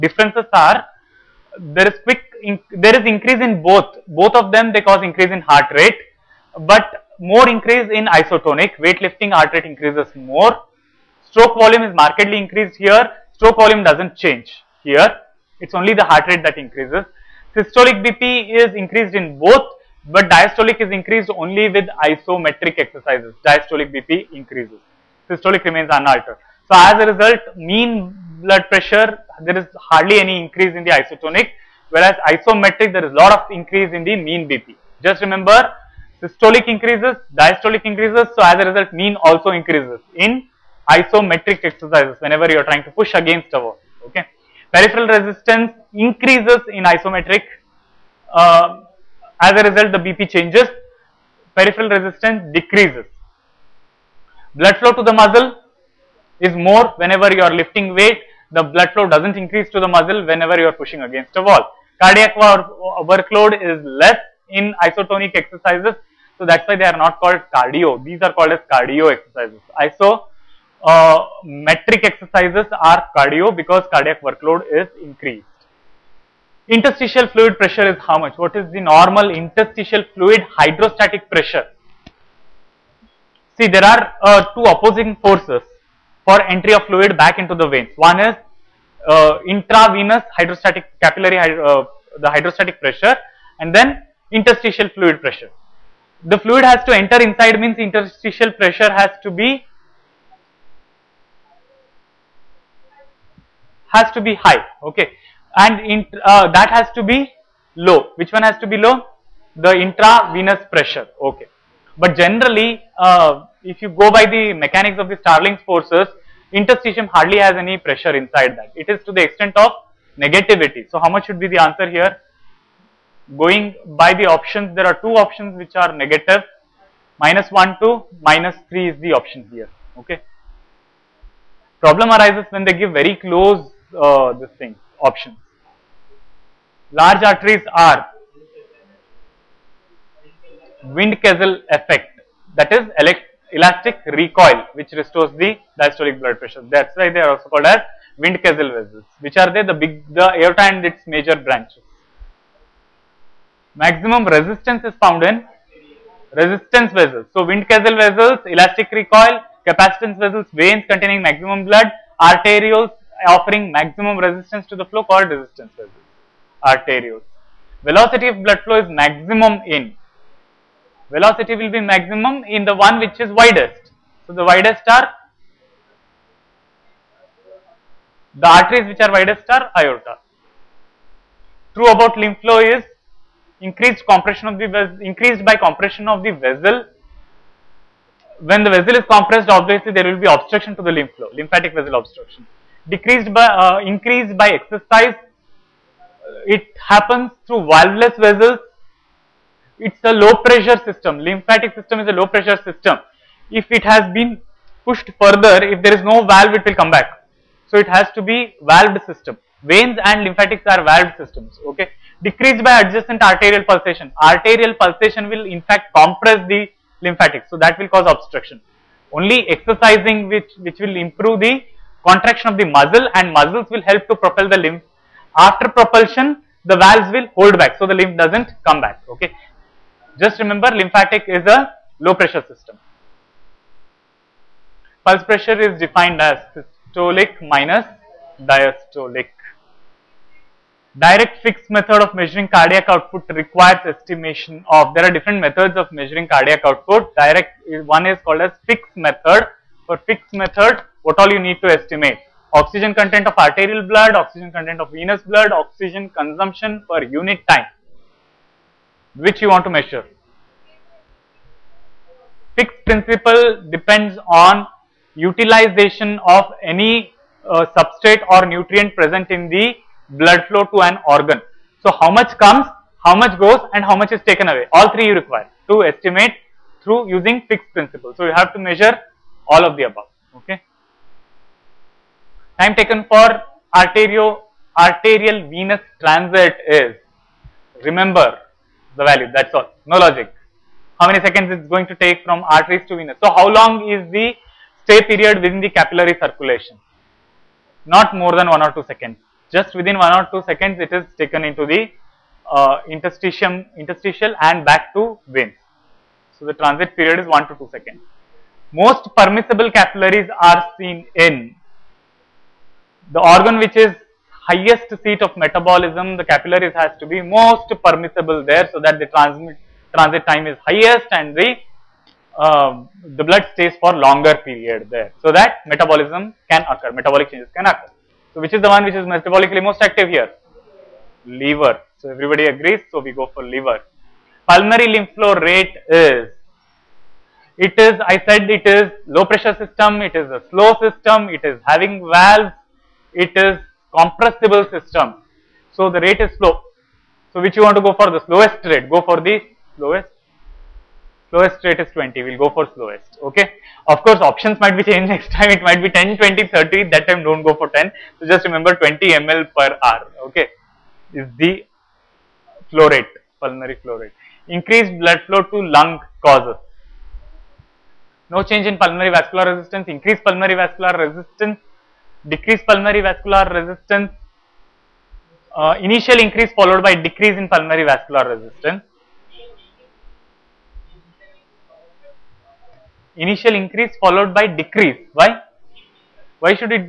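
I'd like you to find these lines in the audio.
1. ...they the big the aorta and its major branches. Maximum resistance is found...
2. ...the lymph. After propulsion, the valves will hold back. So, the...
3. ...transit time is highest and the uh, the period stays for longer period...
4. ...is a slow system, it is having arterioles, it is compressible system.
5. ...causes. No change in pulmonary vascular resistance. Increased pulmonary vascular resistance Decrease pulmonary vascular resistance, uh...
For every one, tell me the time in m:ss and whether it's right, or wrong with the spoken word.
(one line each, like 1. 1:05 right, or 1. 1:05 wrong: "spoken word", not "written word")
1. 2:29 right
2. 3:44 right
3. 5:19 wrong: "blood", not "period"
4. 5:40 wrong: "valves", not "arterioles"
5. 6:06 right.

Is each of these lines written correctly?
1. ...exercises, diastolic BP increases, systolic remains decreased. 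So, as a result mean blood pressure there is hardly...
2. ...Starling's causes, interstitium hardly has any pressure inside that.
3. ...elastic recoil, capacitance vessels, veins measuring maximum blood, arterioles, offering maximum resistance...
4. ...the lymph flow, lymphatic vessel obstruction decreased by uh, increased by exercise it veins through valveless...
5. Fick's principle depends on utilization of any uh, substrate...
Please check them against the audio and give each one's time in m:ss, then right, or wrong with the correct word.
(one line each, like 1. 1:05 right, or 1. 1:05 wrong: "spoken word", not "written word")
1. 0:22 wrong: "unaltered", not "decreased"
2. 1:55 wrong: "forces", not "causes"
3. 2:38 wrong: "containing", not "measuring"
4. 3:10 wrong: "happens", not "veins"
5. 4:22 right.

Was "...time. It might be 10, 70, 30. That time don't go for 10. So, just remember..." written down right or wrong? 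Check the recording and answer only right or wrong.
wrong.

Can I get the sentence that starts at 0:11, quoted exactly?
Stroke volume is markedly increased here.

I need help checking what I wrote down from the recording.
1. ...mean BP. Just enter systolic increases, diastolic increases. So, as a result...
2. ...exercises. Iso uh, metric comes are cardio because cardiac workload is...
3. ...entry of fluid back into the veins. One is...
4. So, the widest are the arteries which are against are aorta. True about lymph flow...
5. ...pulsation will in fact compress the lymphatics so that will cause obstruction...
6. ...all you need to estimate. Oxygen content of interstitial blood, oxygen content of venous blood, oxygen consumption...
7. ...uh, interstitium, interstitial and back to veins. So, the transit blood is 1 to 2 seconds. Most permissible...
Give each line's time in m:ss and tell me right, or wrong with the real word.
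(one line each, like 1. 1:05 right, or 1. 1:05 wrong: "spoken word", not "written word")
1. 0:34 wrong: "remember", not "enter"
2. 1:09 wrong: "exercises", not "comes"
3. 1:26 right
4. 2:54 wrong: "widest", not "against"
5. 3:34 right
6. 4:11 wrong: "arterial", not "interstitial"
7. 5:02 wrong: "period", not "blood".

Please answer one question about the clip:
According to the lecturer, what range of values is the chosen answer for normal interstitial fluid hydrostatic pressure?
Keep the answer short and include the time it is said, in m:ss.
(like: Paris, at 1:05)
-1 to -3, at 2:07.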